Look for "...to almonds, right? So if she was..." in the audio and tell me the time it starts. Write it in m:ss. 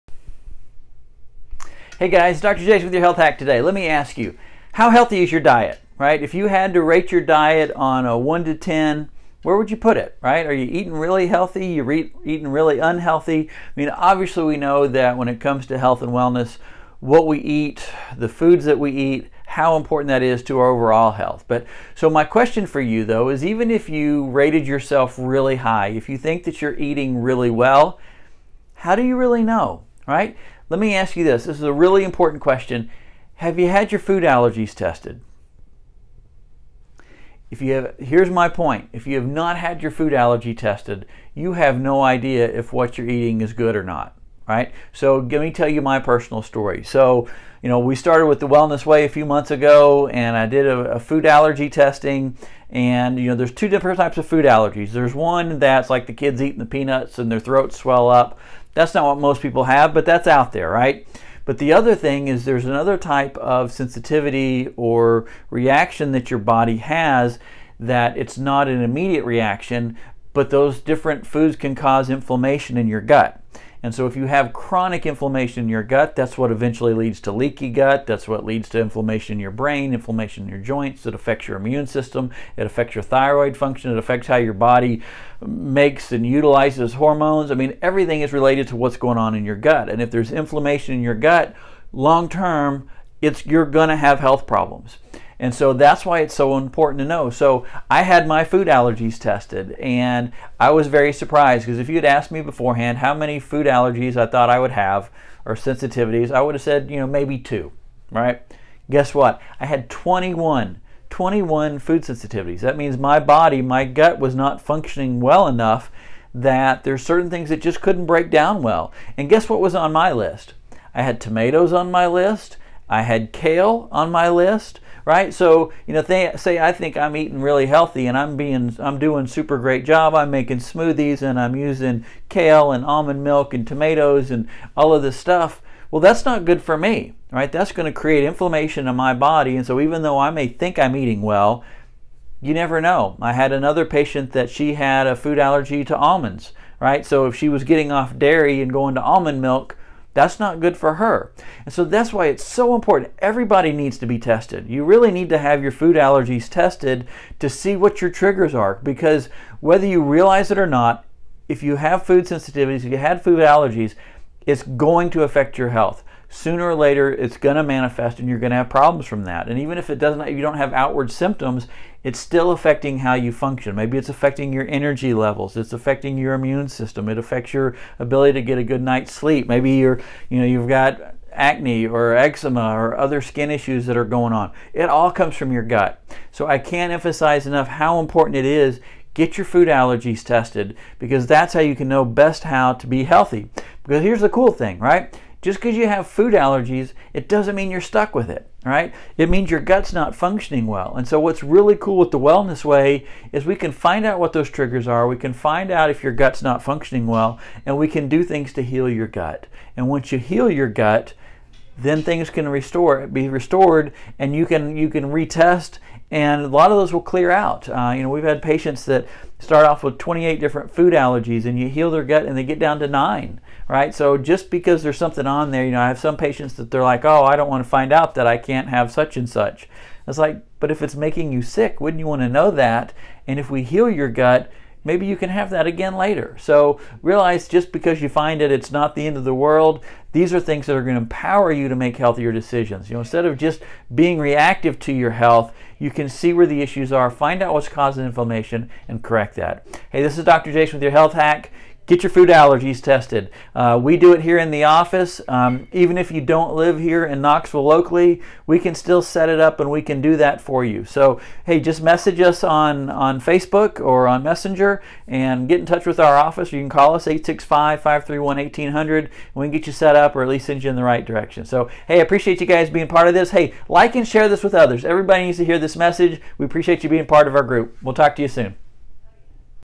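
2:25.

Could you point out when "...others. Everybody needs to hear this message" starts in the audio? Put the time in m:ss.
4:34.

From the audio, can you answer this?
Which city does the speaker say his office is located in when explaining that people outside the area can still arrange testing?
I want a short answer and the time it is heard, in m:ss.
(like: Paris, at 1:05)
Knoxville, at 4:17.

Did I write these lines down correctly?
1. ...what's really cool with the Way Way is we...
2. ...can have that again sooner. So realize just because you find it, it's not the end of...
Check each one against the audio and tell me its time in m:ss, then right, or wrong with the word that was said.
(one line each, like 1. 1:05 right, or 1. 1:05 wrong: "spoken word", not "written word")
1. 3:21 wrong: "Wellness", not "Way"
2. 3:55 wrong: "later", not "sooner".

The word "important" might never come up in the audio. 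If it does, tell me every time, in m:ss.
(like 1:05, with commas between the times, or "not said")
0:19, 0:32, 1:36, 2:32, 3:07.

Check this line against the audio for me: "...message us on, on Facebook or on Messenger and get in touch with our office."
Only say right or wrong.
right.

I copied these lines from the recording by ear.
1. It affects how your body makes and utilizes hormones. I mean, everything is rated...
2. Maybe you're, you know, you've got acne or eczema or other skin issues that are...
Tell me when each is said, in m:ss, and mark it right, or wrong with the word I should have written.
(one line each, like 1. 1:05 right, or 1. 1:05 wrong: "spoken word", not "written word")
1. 1:23 wrong: "related", not "rated"
2. 2:59 right.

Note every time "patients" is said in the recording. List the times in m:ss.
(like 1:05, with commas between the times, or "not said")
2:23, 3:38, 3:46.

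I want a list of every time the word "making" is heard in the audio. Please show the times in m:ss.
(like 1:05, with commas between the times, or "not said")
2:10, 3:50.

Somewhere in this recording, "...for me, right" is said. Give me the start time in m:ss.
2:16.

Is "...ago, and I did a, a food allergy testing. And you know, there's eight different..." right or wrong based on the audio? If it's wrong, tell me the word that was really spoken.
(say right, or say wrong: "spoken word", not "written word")
wrong: "two", not "eight".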